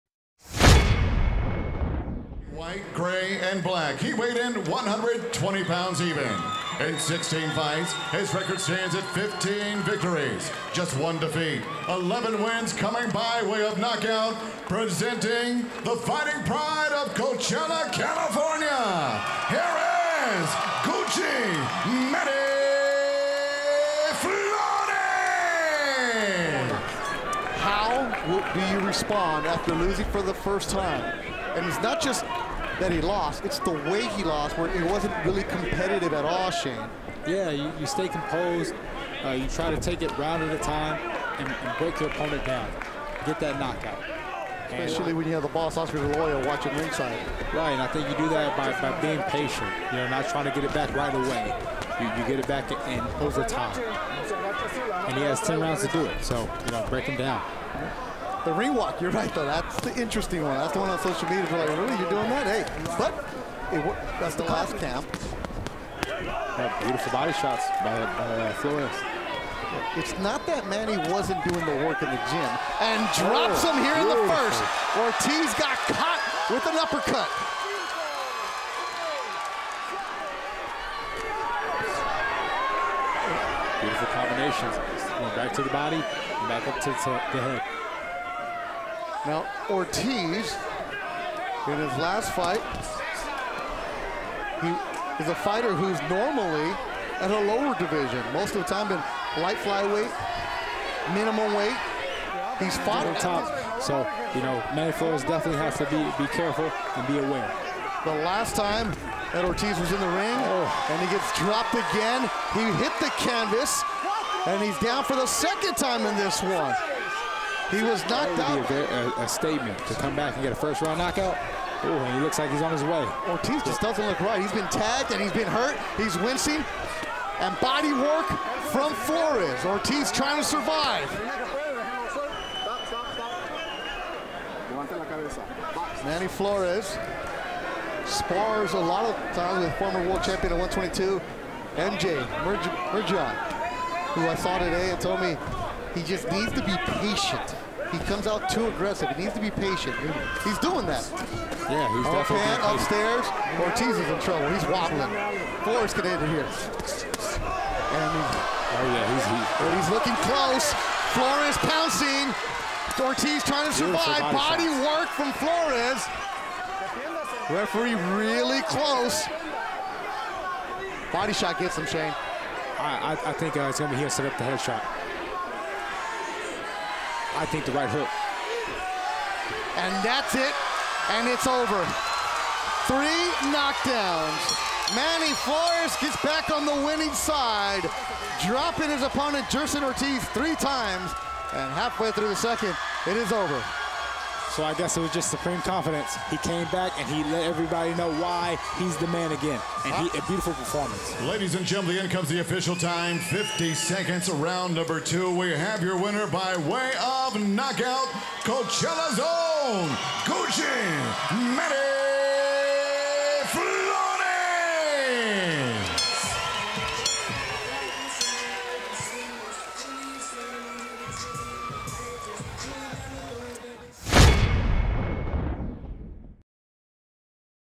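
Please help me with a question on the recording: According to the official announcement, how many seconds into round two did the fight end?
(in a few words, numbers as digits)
50.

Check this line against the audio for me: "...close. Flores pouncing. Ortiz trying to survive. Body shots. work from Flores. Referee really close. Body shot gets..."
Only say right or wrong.
right.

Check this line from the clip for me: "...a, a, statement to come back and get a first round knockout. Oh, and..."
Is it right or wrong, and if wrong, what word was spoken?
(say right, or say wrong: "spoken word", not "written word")
right.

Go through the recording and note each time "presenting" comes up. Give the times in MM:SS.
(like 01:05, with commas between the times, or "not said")
00:14.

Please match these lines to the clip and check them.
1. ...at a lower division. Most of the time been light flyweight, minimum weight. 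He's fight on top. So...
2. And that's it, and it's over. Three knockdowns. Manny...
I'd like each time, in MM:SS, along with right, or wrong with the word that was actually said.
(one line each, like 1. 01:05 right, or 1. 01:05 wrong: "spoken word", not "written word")
1. 01:37 wrong: "fought", not "fight"
2. 02:59 right.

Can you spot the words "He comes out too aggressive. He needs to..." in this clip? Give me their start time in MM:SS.
02:27.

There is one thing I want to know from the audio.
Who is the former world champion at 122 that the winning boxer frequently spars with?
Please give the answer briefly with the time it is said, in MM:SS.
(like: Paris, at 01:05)
MJ Murjan, at 02:21.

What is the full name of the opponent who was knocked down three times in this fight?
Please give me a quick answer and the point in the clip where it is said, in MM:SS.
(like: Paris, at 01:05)
Jerson Ortiz, at 03:09.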